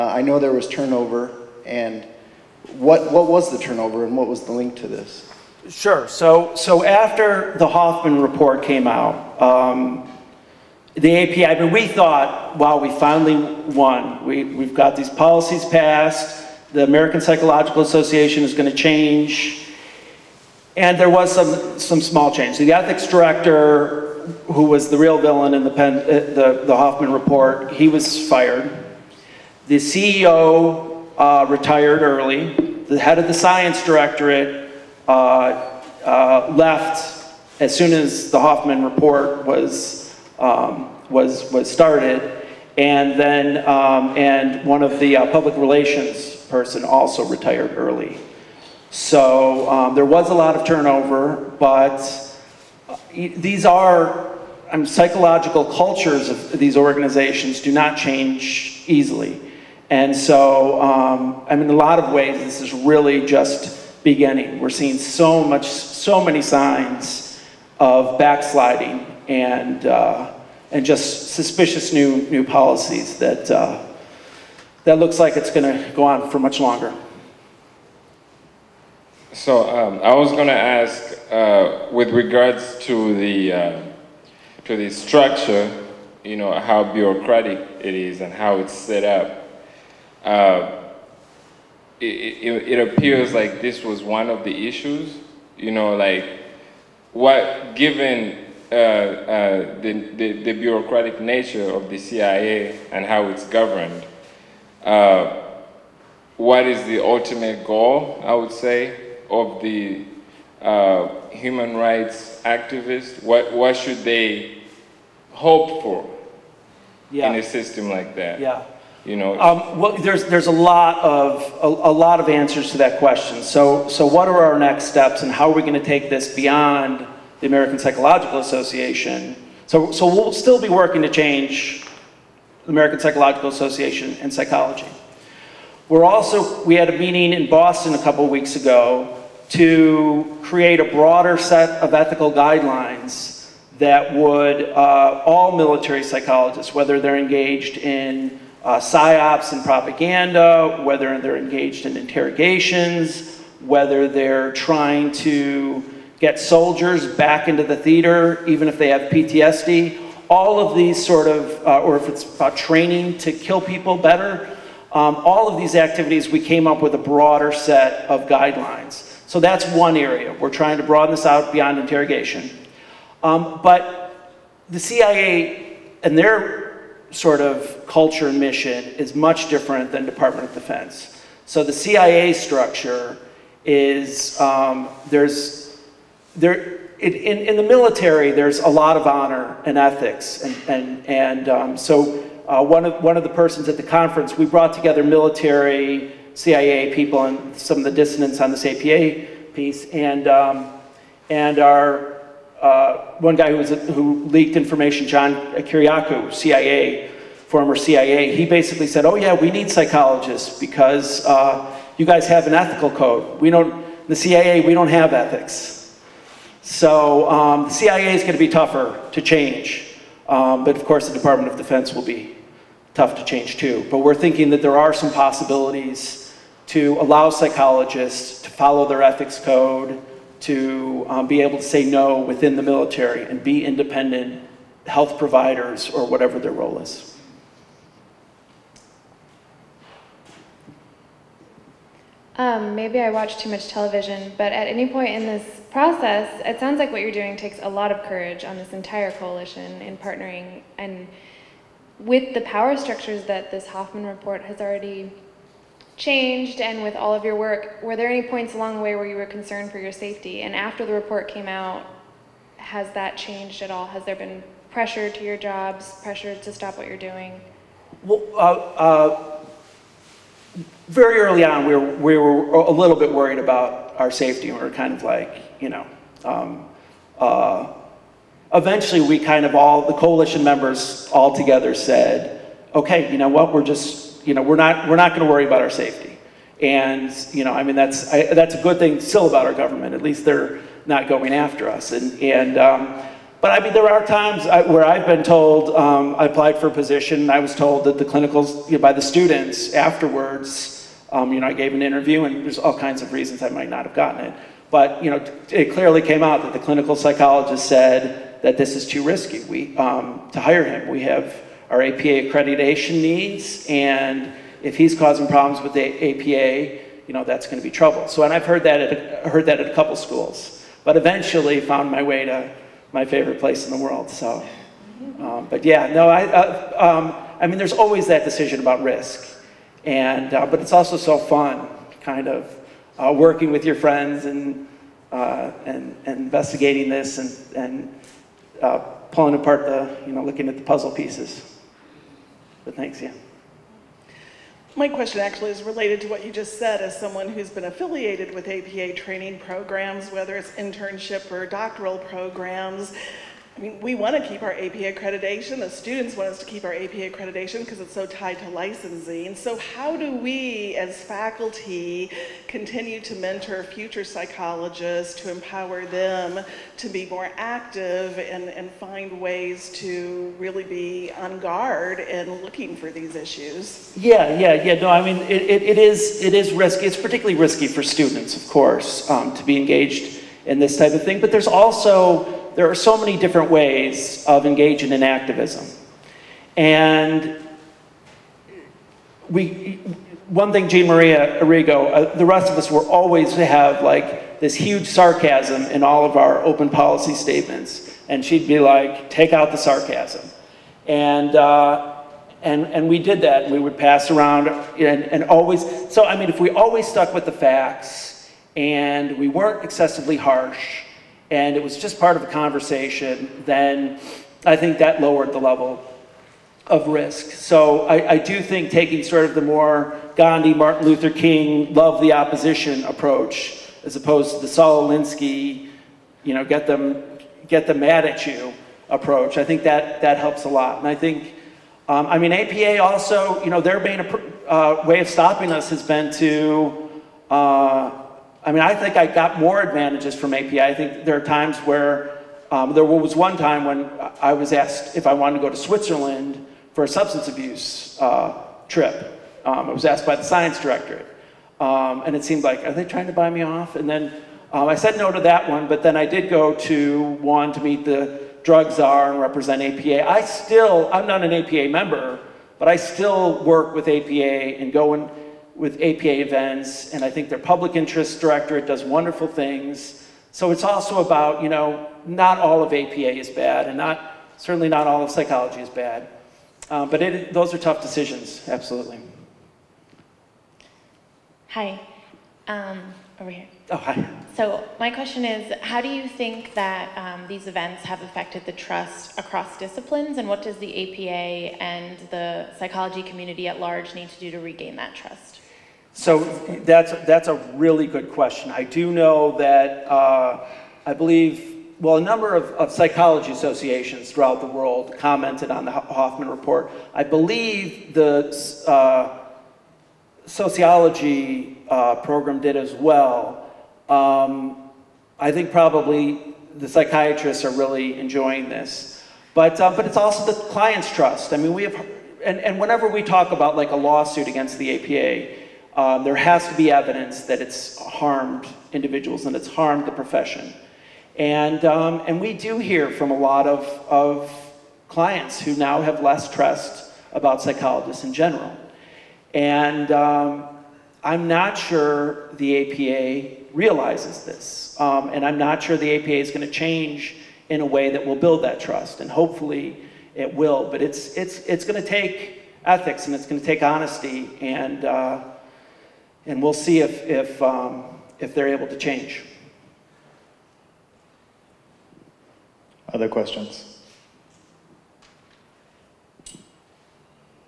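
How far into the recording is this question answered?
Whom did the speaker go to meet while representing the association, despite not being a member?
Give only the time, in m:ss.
7:38.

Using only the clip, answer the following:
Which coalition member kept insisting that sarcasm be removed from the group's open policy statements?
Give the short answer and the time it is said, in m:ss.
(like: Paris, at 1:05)
Jean Maria Arrigo, at 6:30.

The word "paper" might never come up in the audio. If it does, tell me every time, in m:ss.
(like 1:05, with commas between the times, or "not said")
not said.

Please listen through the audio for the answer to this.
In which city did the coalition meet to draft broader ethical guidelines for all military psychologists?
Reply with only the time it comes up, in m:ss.
2:17.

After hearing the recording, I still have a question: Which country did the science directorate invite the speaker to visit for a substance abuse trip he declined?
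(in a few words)
Switzerland.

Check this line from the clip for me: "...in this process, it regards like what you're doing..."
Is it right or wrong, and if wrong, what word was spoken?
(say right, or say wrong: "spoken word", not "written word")
wrong: "sounds", not "regards".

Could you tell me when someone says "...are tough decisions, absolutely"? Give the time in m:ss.
7:57.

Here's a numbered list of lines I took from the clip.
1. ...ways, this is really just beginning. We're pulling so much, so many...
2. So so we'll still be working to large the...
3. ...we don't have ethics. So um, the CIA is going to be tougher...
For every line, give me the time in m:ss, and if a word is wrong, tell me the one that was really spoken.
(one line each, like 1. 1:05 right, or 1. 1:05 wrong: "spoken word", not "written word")
1. 1:02 wrong: "seeing", not "pulling"
2. 2:09 wrong: "change", not "large"
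3. 3:34 right.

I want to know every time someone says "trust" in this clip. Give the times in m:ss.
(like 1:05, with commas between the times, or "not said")
8:08, 8:14, 8:40, 8:56, 9:08.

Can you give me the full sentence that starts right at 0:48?
So um, there was a lot of turnover, but these are um, psychological cultures of these organizations do not change easily.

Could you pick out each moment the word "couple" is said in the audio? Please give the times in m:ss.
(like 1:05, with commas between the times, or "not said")
2:18, 5:19.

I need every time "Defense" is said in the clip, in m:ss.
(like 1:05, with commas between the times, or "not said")
3:00, 3:41.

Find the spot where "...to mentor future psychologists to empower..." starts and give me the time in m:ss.
6:03.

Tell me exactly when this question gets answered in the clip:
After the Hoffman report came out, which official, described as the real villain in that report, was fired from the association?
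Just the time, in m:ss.
0:22.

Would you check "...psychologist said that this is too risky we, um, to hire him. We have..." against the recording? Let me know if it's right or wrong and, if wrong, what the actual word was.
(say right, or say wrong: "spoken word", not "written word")
right.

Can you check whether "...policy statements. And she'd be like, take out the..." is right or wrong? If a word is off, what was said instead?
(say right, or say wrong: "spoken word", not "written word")
right.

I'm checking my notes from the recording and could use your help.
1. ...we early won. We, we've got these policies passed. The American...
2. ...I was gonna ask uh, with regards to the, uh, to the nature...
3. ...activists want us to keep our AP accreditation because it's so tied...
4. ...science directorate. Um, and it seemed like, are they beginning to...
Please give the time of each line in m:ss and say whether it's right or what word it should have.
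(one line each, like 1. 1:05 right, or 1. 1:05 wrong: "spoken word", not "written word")
1. 0:12 wrong: "finally", not "early"
2. 1:20 wrong: "structure", not "nature"
3. 5:55 wrong: "students", not "activists"
4. 7:30 wrong: "trying", not "beginning".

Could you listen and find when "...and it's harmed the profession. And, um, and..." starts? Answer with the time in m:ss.
8:49.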